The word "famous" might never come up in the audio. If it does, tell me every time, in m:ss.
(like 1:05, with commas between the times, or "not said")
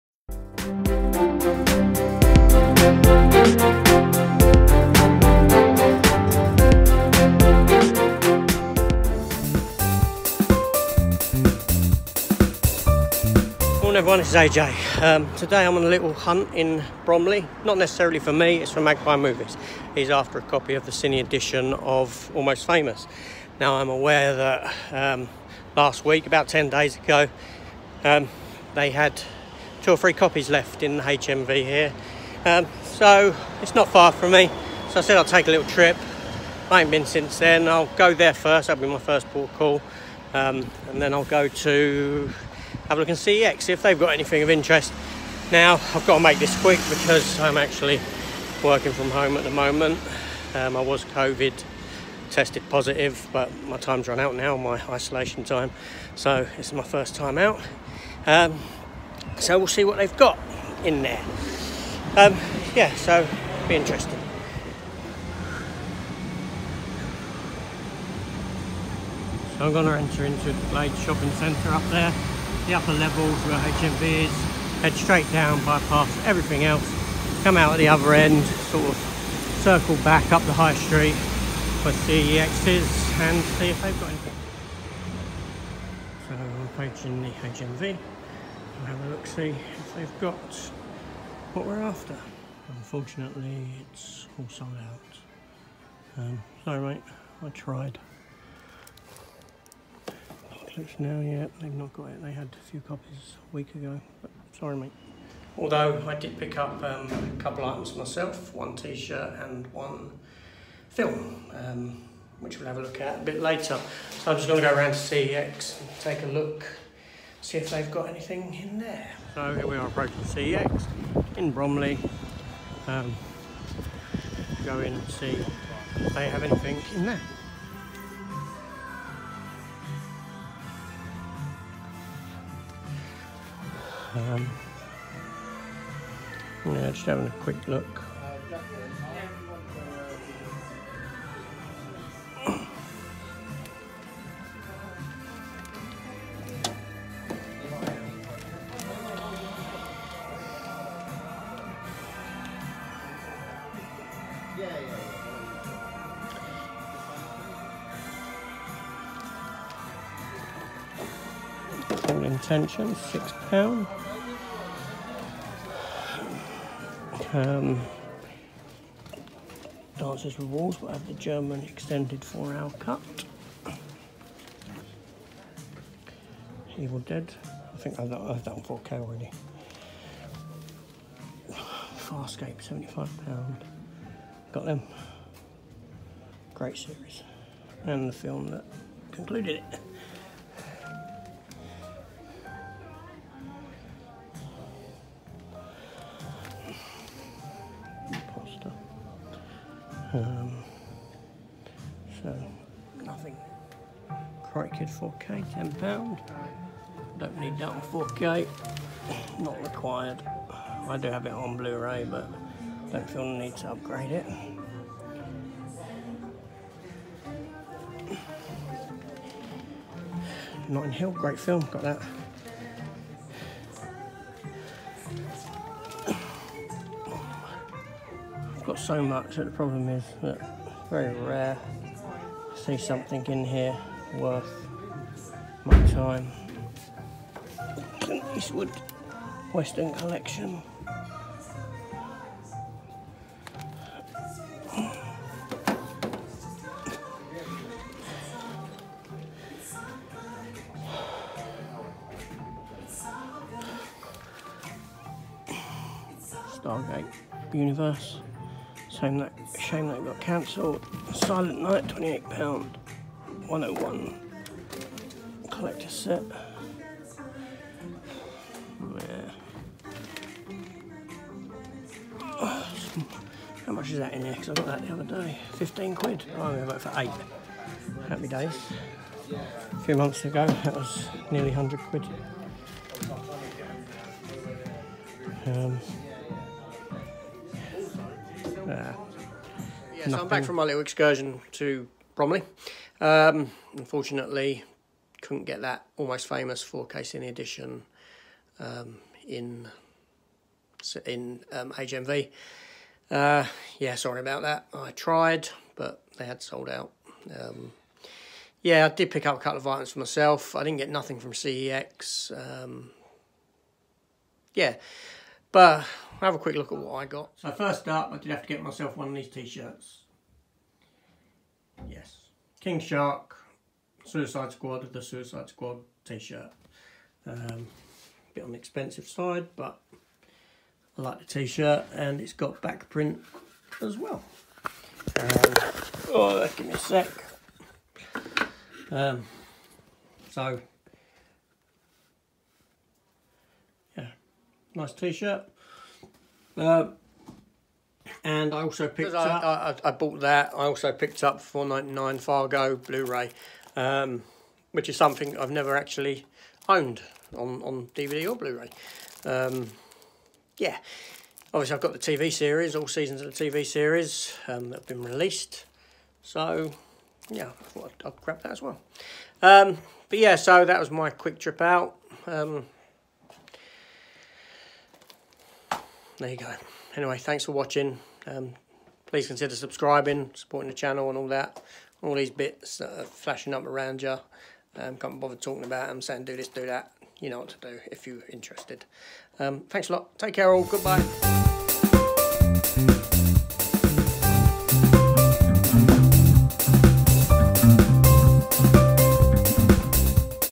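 0:22, 4:56.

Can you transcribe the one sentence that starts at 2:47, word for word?
Um, Dances with We will have the German extended four hour cut.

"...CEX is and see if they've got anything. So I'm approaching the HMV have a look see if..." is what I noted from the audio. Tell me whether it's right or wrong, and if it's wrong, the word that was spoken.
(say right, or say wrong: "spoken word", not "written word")
right.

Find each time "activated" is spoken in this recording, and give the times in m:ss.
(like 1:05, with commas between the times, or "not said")
not said.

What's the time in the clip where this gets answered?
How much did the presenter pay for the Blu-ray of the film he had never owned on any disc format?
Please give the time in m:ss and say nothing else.
5:51.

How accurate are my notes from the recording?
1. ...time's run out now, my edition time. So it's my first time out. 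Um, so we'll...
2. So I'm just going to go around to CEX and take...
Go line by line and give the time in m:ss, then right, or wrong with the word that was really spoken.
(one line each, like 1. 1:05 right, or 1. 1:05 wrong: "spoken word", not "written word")
1. 0:53 wrong: "isolation", not "edition"
2. 1:54 right.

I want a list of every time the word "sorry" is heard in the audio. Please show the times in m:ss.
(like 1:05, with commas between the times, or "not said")
1:36, 1:44, 5:03.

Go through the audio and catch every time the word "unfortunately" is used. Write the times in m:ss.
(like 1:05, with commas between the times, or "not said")
1:32, 4:53.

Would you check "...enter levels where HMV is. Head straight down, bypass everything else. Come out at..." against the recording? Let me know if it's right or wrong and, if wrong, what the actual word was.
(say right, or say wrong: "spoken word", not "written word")
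wrong: "upper", not "enter".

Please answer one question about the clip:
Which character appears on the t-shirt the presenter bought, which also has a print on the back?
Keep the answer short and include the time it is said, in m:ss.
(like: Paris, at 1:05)
King Shark, at 5:22.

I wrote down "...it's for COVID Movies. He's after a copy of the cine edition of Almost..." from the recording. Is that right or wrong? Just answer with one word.
wrong.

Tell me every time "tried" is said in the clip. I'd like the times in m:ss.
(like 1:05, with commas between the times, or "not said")
1:37, 5:04.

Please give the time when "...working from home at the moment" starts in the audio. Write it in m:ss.
0:48.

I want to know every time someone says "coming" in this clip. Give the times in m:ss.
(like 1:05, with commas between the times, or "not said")
not said.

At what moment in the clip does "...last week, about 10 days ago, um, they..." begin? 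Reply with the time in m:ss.
0:25.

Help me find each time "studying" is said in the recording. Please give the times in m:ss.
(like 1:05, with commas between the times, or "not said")
not said.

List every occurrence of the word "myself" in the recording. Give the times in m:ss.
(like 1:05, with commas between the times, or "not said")
1:47, 5:09, 5:18.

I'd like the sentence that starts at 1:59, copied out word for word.
So here we are approaching CEX in Bromley.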